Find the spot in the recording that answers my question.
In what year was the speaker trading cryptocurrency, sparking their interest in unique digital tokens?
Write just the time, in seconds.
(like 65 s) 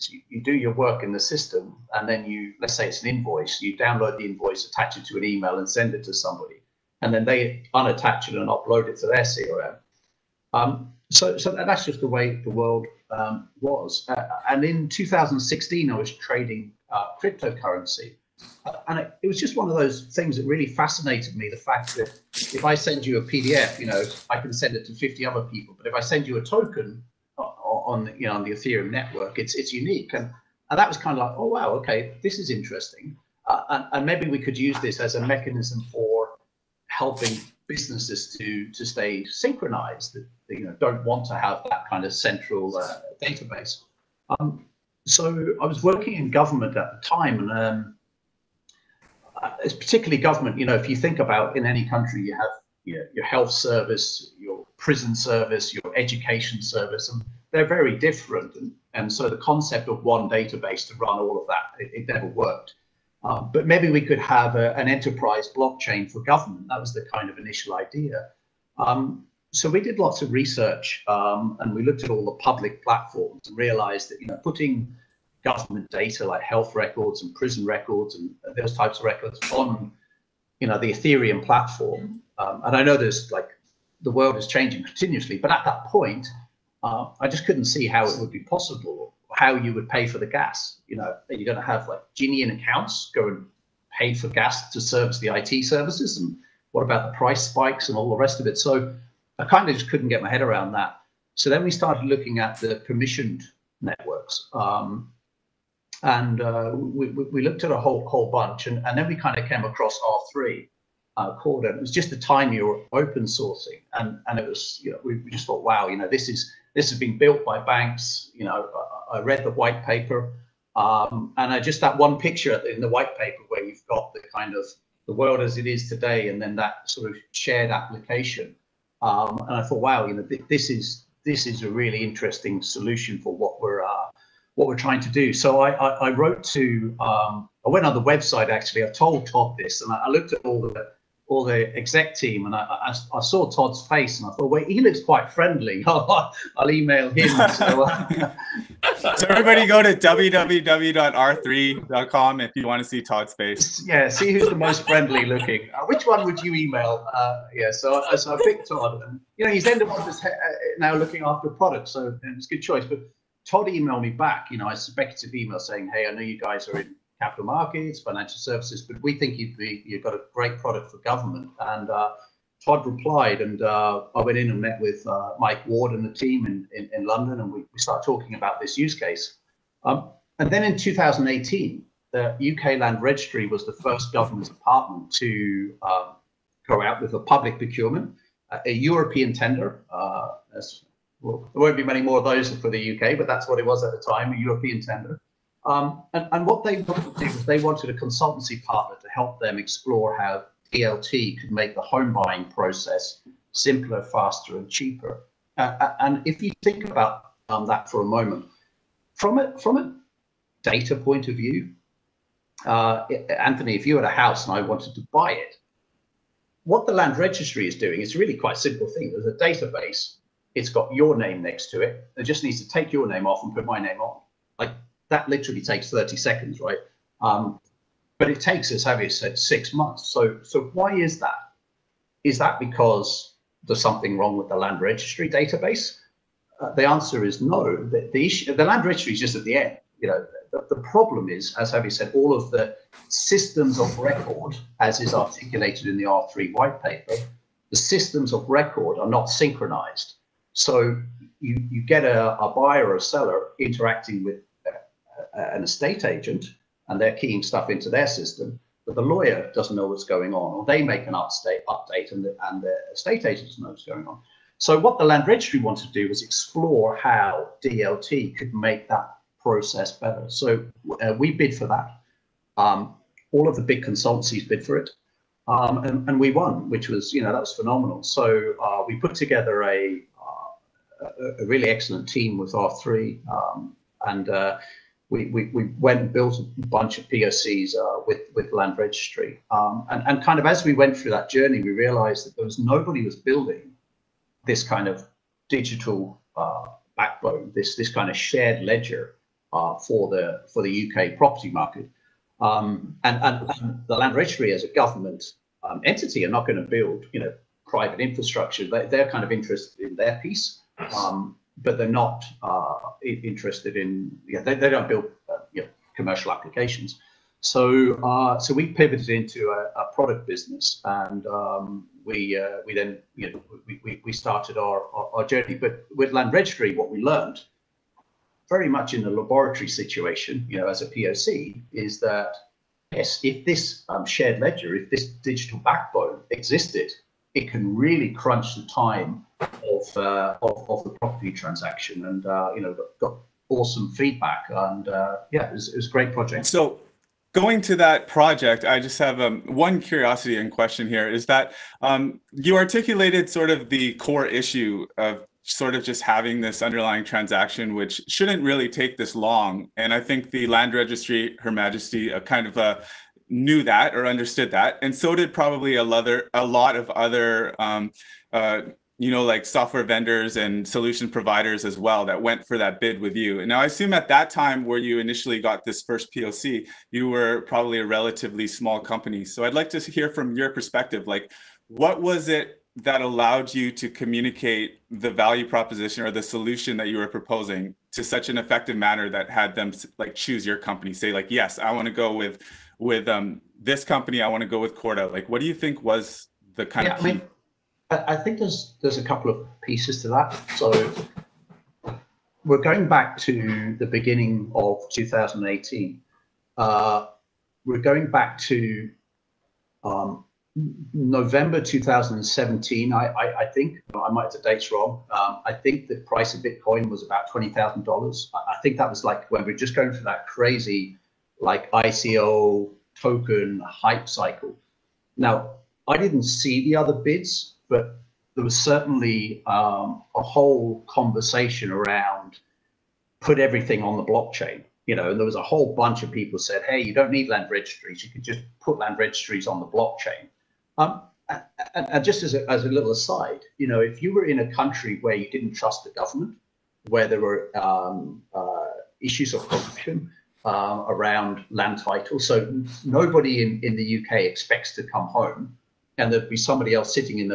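14 s.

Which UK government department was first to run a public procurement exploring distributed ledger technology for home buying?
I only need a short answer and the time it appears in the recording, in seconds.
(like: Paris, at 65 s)
UK Land Registry, at 182 s.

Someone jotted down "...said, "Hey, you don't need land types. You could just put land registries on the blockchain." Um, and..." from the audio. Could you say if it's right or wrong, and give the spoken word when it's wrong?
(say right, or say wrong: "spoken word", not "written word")
wrong: "registries", not "types".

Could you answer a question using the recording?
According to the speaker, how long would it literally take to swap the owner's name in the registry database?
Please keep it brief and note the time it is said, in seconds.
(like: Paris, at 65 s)
30 seconds, at 225 s.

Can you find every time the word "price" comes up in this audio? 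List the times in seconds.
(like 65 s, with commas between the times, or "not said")
97 s, 416 s.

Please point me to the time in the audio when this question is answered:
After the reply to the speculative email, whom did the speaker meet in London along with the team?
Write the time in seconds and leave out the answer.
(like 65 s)
175 s.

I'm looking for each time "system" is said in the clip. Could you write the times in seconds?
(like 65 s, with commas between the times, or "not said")
1 s, 243 s, 247 s, 258 s.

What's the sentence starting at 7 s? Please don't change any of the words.
And then they unattach it and upload it to their CRM.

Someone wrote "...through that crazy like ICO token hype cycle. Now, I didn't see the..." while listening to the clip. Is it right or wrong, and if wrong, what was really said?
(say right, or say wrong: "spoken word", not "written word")
right.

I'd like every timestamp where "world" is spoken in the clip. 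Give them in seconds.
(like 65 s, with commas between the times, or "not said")
12 s, 84 s, 125 s.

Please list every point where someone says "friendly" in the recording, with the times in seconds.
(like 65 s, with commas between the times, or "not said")
145 s, 154 s.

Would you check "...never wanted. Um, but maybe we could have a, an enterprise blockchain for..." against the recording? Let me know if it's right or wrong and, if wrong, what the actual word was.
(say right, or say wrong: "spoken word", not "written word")
wrong: "worked", not "wanted".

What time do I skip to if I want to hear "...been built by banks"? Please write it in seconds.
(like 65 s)
116 s.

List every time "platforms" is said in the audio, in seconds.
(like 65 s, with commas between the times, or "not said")
72 s, 81 s.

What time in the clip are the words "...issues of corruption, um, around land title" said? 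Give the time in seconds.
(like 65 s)
449 s.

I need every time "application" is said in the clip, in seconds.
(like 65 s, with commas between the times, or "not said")
127 s, 316 s.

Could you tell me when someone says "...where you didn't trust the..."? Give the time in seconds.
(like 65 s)
445 s.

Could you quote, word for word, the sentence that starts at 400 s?
So we're going back to the beginning of 2018.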